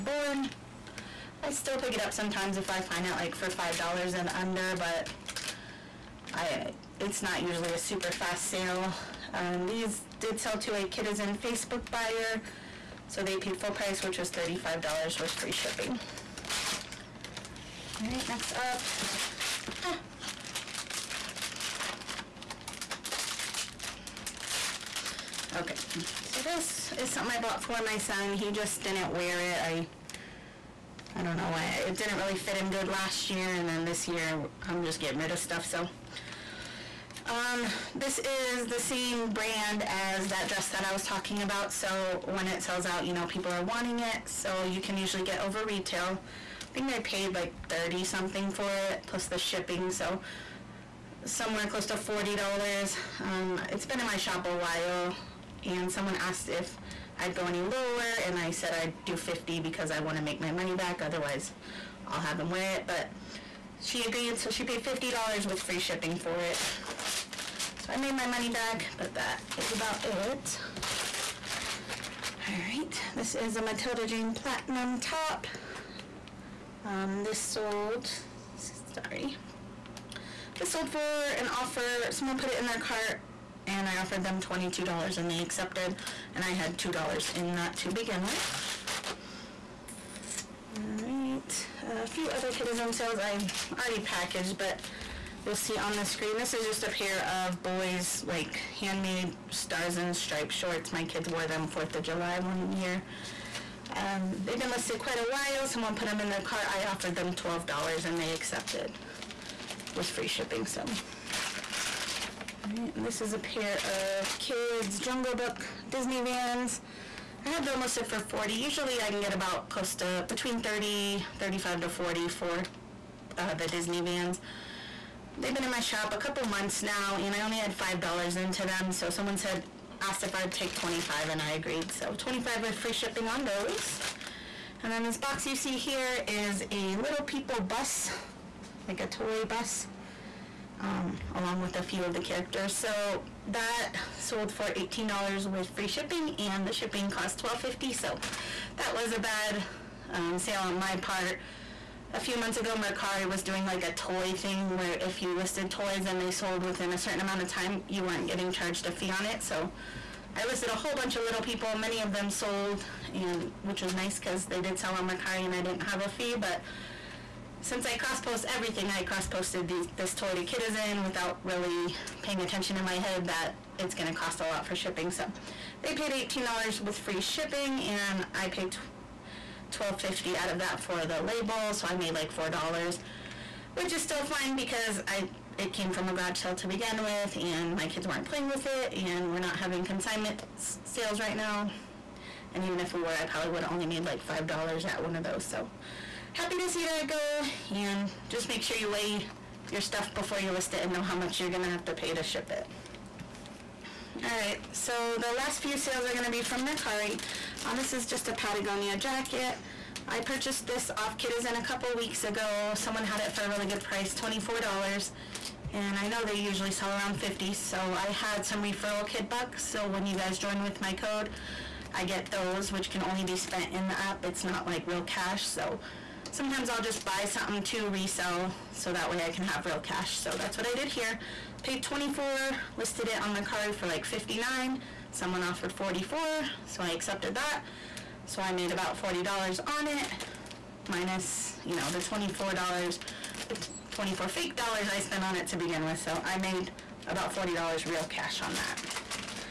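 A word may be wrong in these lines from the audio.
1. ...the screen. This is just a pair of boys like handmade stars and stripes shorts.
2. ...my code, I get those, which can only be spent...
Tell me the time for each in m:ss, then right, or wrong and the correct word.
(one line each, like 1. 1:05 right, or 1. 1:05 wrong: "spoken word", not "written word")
1. 1:35 right
2. 3:40 right.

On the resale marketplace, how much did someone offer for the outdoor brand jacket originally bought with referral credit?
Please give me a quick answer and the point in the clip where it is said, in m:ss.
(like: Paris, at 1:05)
$44, at 3:55.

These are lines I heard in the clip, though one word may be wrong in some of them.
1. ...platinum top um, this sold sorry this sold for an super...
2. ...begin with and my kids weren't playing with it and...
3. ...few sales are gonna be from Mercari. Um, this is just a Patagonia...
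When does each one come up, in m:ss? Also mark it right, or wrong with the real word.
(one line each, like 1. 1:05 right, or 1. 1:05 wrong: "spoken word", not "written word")
1. 1:14 wrong: "offer", not "super"
2. 3:06 right
3. 3:25 right.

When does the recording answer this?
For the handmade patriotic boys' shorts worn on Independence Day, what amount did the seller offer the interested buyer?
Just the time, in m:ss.
1:47.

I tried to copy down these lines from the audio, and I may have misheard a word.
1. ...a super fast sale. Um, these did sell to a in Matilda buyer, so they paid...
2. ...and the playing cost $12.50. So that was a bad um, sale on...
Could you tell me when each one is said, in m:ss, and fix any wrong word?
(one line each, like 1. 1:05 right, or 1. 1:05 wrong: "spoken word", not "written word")
1. 0:07 wrong: "Facebook", not "Matilda"
2. 2:26 wrong: "shipping", not "playing".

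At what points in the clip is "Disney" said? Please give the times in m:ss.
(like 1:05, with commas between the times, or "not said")
1:55, 2:03.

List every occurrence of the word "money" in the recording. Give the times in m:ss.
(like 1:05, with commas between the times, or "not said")
1:00, 1:08.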